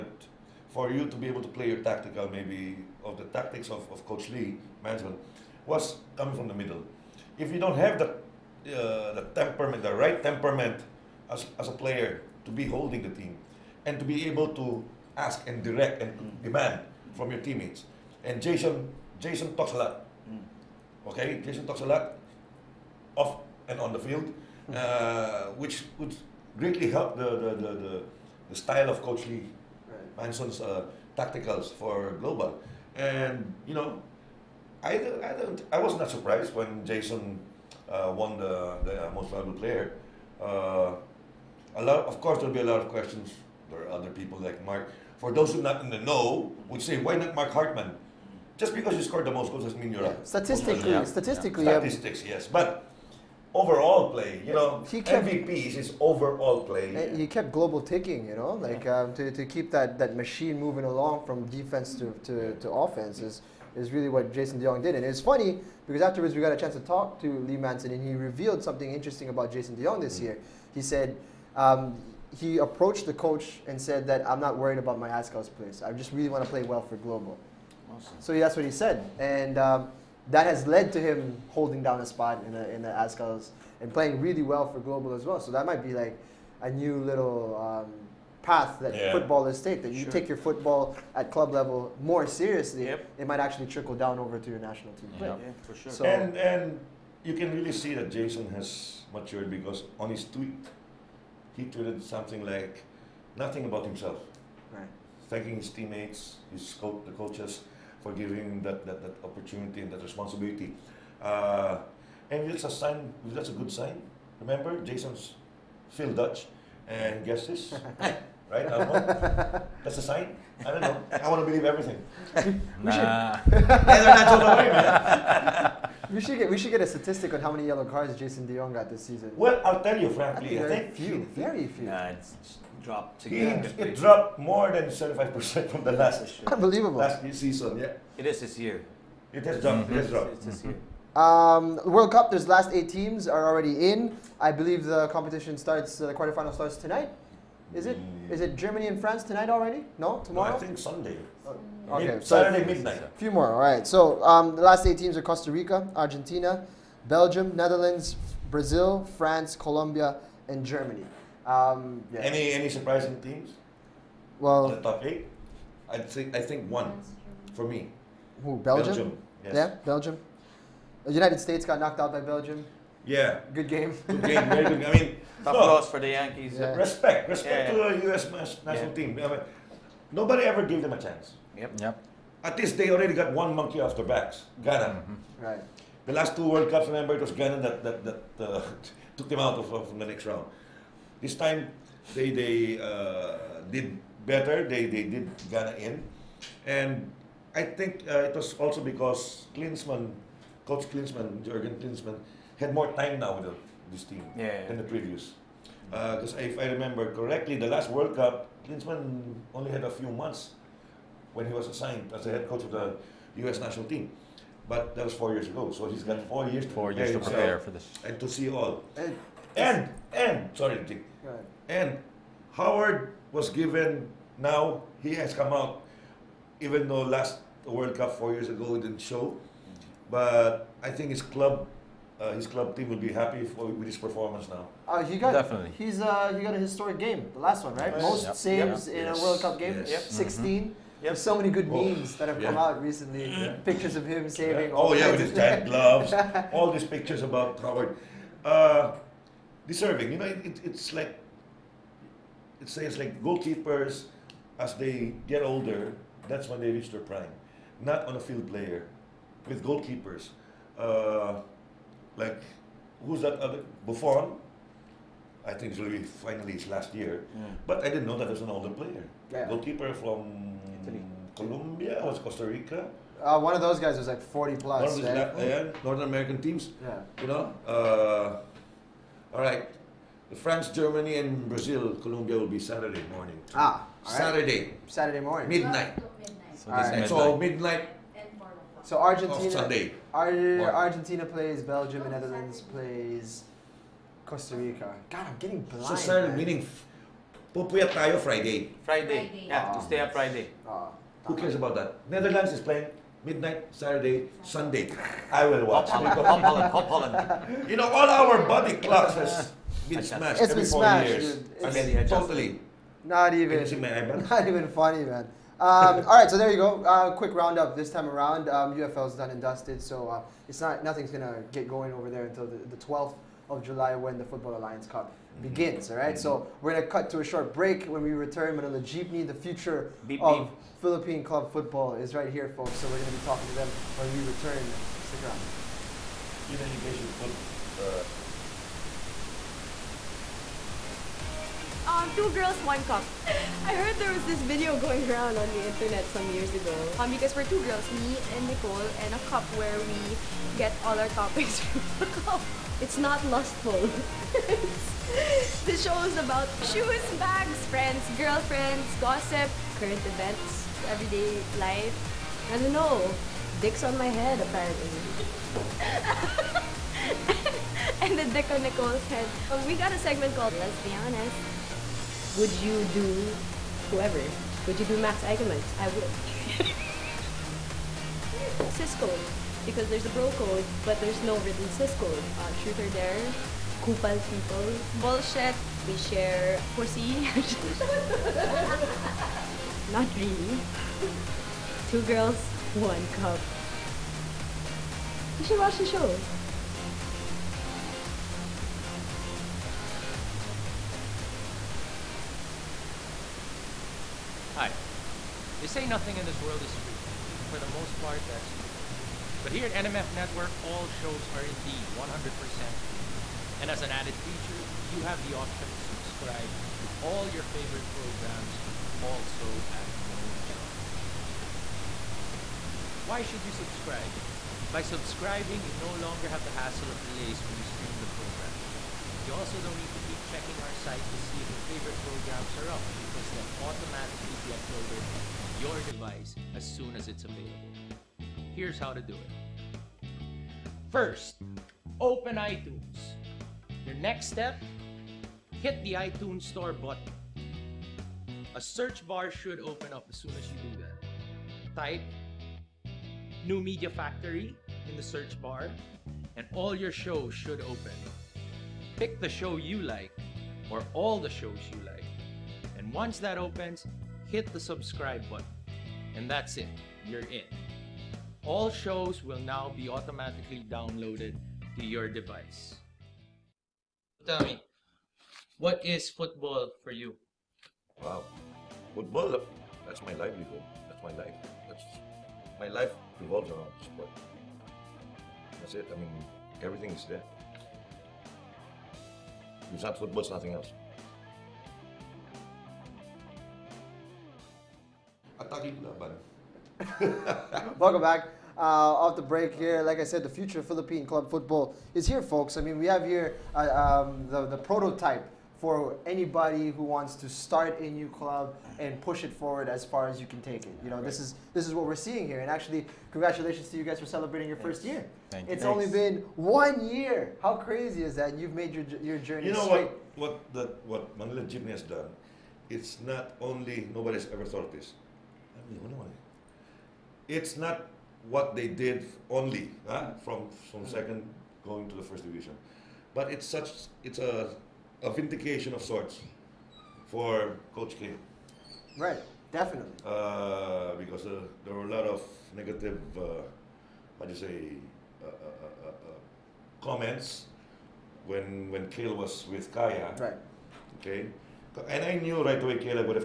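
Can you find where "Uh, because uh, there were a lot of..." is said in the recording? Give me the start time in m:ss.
9:00.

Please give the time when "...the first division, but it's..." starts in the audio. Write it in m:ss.
8:51.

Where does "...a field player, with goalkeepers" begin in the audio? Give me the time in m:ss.
4:18.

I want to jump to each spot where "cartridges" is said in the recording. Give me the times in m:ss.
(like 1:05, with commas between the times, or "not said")
not said.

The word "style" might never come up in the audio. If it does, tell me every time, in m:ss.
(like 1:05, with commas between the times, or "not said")
0:28.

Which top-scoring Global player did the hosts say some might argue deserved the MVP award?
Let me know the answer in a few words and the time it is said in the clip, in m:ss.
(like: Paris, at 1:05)
Mark Hartmann, at 0:47.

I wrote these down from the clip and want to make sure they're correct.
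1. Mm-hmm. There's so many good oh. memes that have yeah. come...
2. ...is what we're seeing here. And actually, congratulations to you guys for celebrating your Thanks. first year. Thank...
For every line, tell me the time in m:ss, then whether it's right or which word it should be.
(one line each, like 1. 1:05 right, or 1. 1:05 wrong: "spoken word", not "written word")
1. 4:00 right
2. 8:31 right.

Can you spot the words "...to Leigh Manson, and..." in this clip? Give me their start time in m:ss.
1:07.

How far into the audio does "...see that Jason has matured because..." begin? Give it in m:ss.
1:37.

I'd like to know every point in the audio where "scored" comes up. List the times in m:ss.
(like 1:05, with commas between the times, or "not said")
0:49.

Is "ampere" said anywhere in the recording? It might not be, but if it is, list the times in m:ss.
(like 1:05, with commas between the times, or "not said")
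not said.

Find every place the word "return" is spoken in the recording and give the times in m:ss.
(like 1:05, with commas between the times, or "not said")
5:28, 5:34.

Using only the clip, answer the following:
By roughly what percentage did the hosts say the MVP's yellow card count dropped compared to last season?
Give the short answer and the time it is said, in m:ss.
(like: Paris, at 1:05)
75%, at 2:14.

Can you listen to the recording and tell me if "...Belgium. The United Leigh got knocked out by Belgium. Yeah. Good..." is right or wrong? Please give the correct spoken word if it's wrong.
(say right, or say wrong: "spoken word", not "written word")
wrong: "States", not "Leigh".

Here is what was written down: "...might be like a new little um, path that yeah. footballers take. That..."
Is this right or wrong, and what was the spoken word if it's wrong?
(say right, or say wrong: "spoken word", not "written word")
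right.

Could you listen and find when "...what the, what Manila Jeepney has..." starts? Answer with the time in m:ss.
8:40.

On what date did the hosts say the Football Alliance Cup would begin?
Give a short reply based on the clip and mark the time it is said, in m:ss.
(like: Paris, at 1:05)
12 July, at 5:22.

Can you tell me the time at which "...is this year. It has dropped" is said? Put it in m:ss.
2:18.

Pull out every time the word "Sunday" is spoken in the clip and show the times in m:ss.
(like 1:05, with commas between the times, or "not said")
2:30, 4:49, 5:04.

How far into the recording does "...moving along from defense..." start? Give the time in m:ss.
1:00.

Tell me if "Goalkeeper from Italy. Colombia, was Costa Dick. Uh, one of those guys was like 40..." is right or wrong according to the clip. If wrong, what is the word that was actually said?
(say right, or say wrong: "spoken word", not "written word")
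wrong: "Rica", not "Dick".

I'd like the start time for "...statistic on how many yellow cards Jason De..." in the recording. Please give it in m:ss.
2:06.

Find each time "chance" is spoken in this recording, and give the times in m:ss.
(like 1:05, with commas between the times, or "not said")
1:06, 3:01.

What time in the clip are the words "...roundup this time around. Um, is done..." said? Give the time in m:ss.
5:17.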